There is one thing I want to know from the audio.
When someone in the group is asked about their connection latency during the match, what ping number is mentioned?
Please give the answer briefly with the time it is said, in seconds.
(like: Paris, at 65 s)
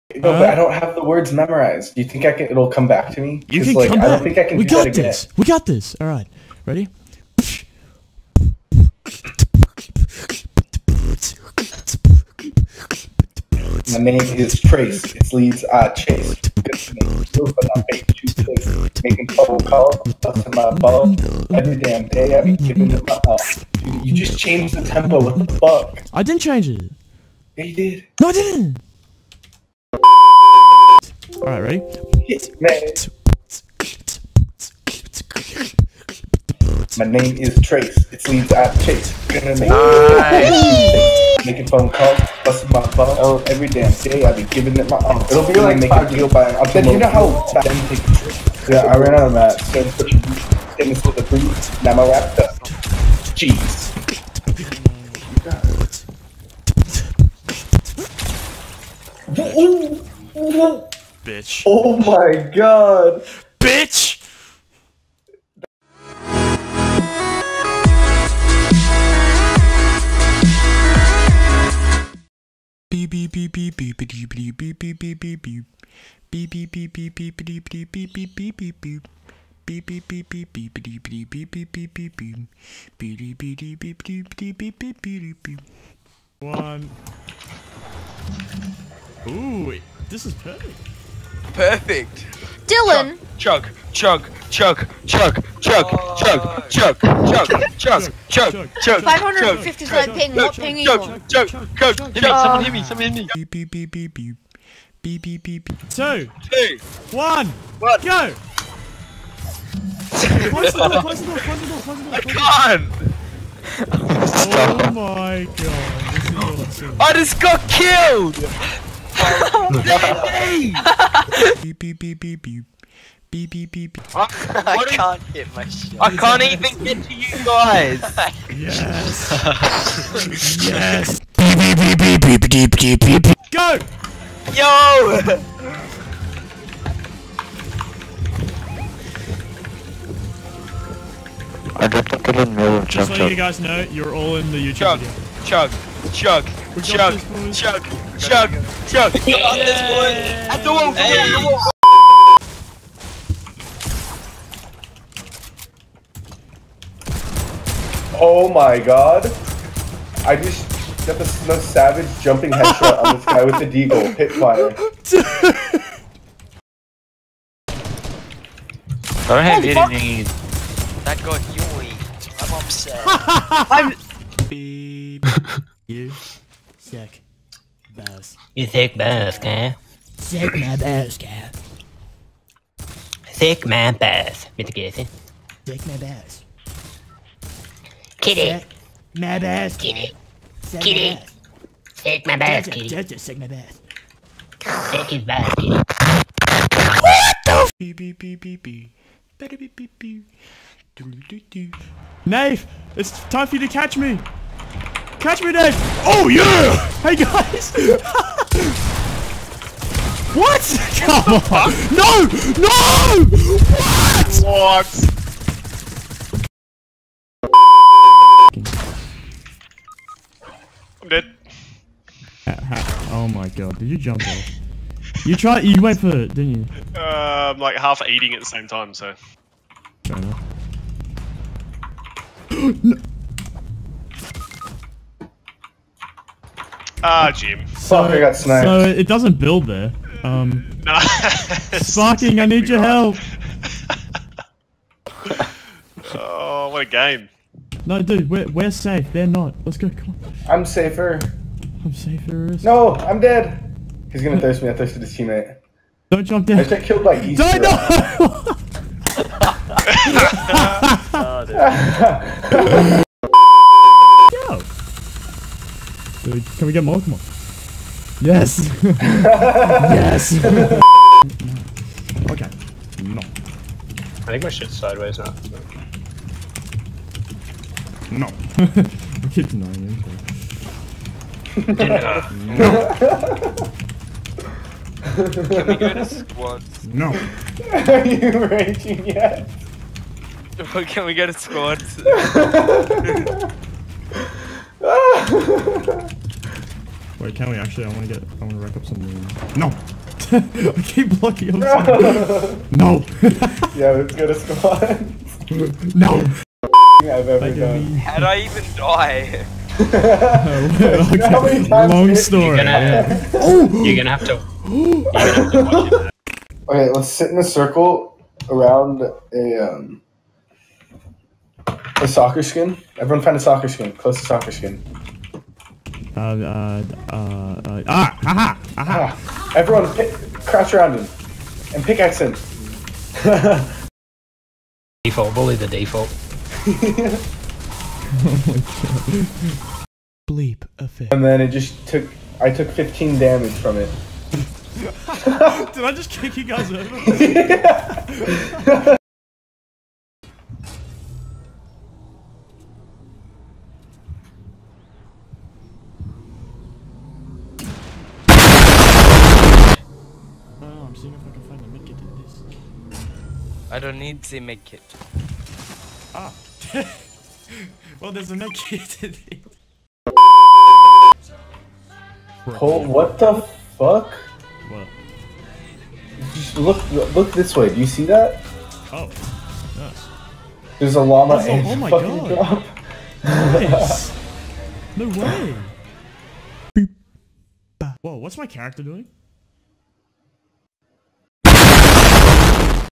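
555, at 99 s.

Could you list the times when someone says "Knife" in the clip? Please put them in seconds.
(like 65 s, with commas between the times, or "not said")
202 s.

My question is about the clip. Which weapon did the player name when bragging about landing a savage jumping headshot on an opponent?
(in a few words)
Deagle.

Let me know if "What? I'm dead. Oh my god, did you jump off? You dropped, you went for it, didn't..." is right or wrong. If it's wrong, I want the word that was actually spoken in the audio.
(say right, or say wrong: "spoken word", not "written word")
wrong: "tried", not "dropped".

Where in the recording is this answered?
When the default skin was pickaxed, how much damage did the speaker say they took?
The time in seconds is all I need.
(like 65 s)
342 s.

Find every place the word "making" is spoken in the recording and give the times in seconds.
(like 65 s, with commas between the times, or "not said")
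19 s, 41 s, 45 s.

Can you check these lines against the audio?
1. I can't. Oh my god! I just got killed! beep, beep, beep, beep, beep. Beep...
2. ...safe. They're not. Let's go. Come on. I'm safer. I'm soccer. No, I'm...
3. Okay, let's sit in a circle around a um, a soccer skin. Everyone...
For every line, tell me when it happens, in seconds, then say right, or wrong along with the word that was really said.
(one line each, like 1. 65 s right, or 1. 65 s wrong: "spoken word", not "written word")
1. 112 s right
2. 248 s wrong: "safer", not "soccer"
3. 316 s right.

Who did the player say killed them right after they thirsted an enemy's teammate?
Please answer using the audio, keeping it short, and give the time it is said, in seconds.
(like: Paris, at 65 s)
Easter, at 257 s.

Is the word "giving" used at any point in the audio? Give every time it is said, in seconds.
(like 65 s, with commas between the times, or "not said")
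22 s, 44 s.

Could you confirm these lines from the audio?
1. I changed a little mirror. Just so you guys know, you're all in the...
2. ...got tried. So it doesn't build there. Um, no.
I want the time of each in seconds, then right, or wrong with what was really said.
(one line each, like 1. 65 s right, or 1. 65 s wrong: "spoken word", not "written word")
1. 141 s wrong: "dropped", not "changed"
2. 238 s wrong: "sniped", not "tried".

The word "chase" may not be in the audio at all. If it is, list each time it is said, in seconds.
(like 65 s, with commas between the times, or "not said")
15 s, 38 s.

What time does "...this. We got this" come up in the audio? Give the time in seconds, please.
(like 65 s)
4 s.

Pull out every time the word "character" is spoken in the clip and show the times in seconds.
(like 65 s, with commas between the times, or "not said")
388 s.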